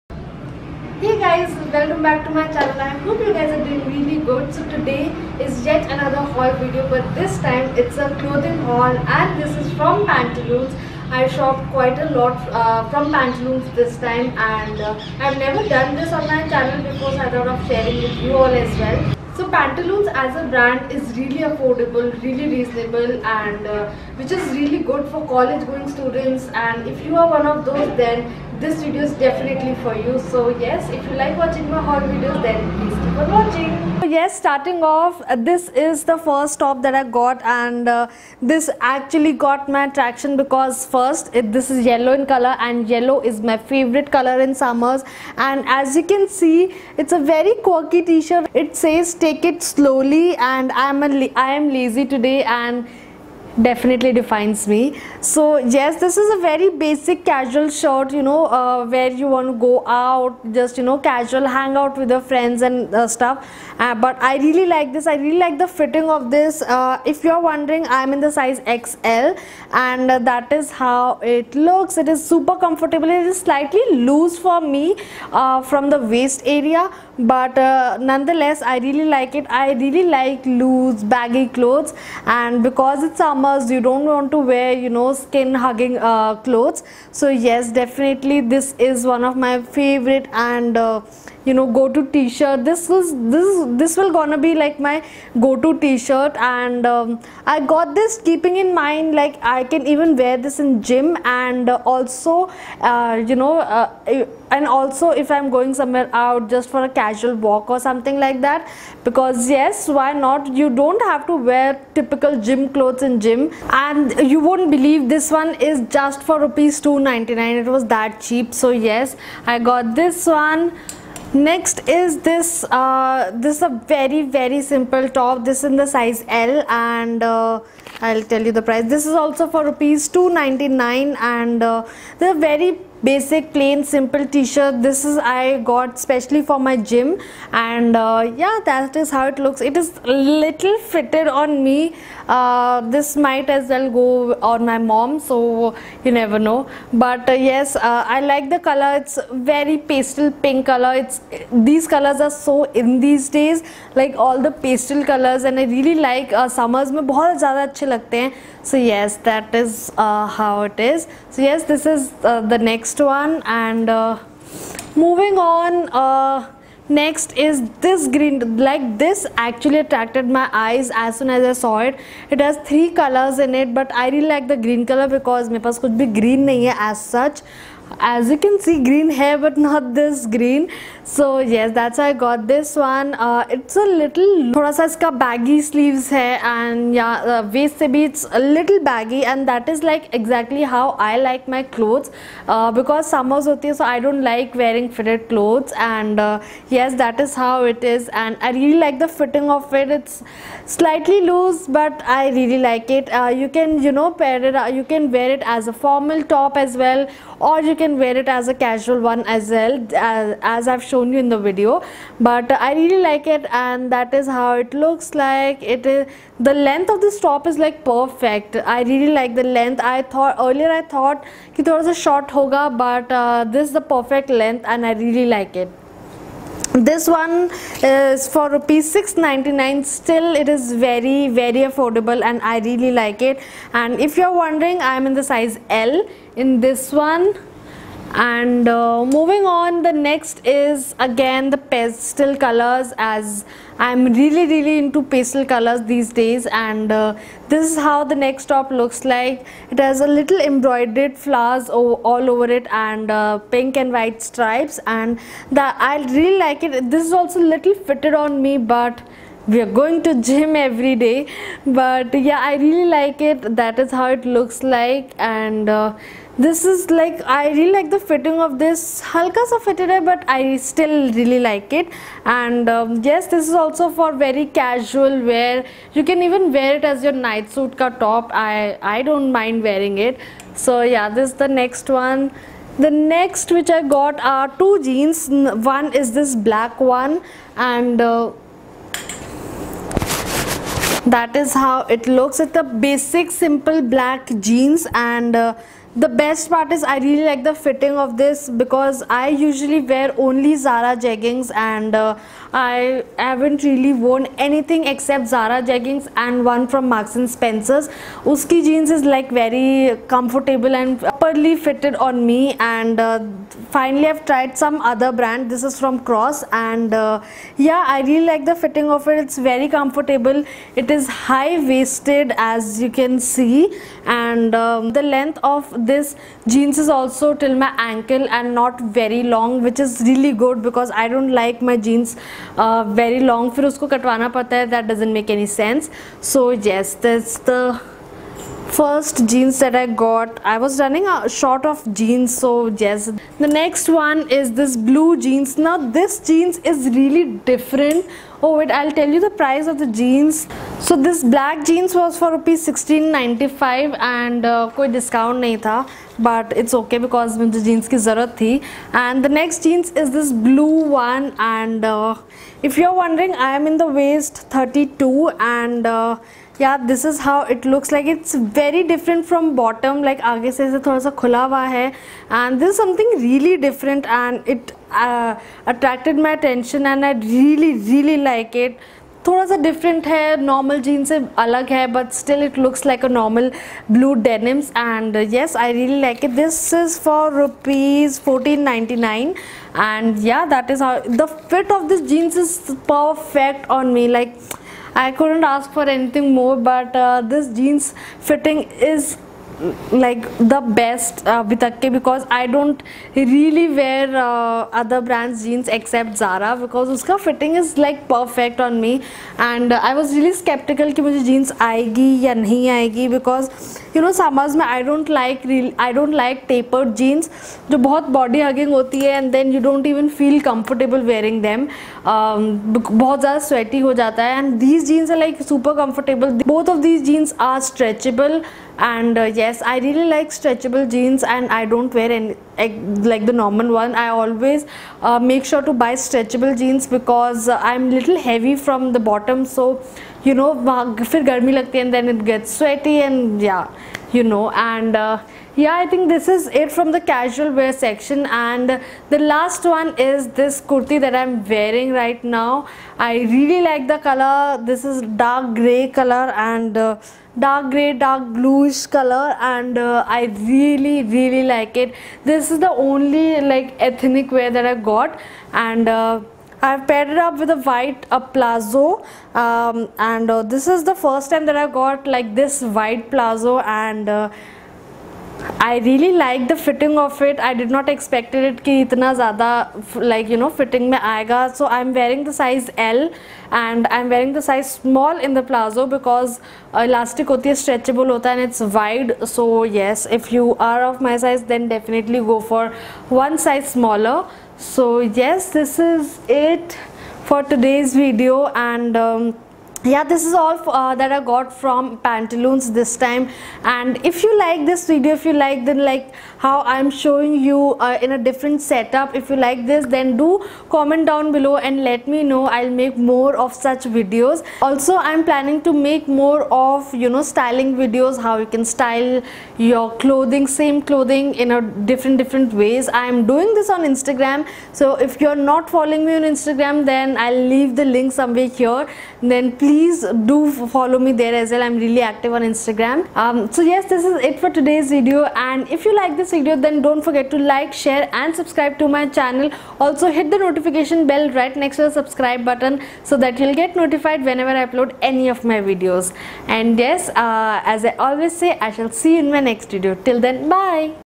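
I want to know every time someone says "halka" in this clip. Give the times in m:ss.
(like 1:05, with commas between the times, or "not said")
4:29.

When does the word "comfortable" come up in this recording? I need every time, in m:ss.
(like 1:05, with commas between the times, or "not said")
1:12, 5:10, 5:19, 7:00, 7:05.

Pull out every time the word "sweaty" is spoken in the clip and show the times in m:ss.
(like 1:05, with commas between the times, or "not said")
7:03, 7:22.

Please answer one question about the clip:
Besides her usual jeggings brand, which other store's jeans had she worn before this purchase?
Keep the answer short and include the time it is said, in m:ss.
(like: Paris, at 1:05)
Marks and Spencer's, at 5:06.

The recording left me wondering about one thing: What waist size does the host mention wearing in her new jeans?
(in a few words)
32.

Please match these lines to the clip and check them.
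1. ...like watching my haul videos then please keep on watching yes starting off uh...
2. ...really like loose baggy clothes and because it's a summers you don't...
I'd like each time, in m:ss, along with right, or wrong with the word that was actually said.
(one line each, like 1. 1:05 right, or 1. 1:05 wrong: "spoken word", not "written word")
1. 0:31 right
2. 1:19 right.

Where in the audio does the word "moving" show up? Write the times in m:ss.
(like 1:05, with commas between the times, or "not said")
2:44, 3:59.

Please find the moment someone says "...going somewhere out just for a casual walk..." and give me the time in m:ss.
1:45.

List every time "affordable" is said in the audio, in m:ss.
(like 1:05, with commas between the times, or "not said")
0:21, 3:51.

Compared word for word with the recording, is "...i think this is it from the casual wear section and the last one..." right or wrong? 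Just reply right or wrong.
right.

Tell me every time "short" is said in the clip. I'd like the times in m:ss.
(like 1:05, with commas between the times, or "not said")
3:42, 5:41.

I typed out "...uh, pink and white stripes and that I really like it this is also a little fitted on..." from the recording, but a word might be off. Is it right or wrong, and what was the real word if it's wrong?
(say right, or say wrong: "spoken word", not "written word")
right.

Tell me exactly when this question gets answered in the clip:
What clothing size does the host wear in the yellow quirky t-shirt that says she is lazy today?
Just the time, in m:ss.
1:08.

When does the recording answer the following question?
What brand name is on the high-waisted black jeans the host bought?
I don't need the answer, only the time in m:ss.
5:16.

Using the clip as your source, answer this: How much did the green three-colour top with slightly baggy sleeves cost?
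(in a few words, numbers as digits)
Rs 699.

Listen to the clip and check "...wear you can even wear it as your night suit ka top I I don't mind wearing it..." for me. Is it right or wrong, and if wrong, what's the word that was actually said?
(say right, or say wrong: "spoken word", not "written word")
right.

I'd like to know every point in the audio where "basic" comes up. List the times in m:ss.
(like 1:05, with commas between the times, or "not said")
0:56, 2:13, 4:52.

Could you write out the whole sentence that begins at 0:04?
So today is yet another haul video but this time it's a clothing haul and this is from Pantaloons.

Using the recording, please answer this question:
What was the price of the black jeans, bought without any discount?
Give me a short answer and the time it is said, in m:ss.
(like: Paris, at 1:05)
Rs 1695, at 5:52.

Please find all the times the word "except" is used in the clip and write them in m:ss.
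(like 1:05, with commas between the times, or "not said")
5:04, 6:45.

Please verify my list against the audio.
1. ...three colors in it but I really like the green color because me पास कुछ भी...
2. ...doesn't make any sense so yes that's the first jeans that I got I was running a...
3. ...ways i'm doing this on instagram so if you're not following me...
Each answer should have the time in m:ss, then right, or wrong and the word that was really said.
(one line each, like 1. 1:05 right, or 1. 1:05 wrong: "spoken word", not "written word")
1. 2:52 right
2. 5:34 right
3. 8:42 right.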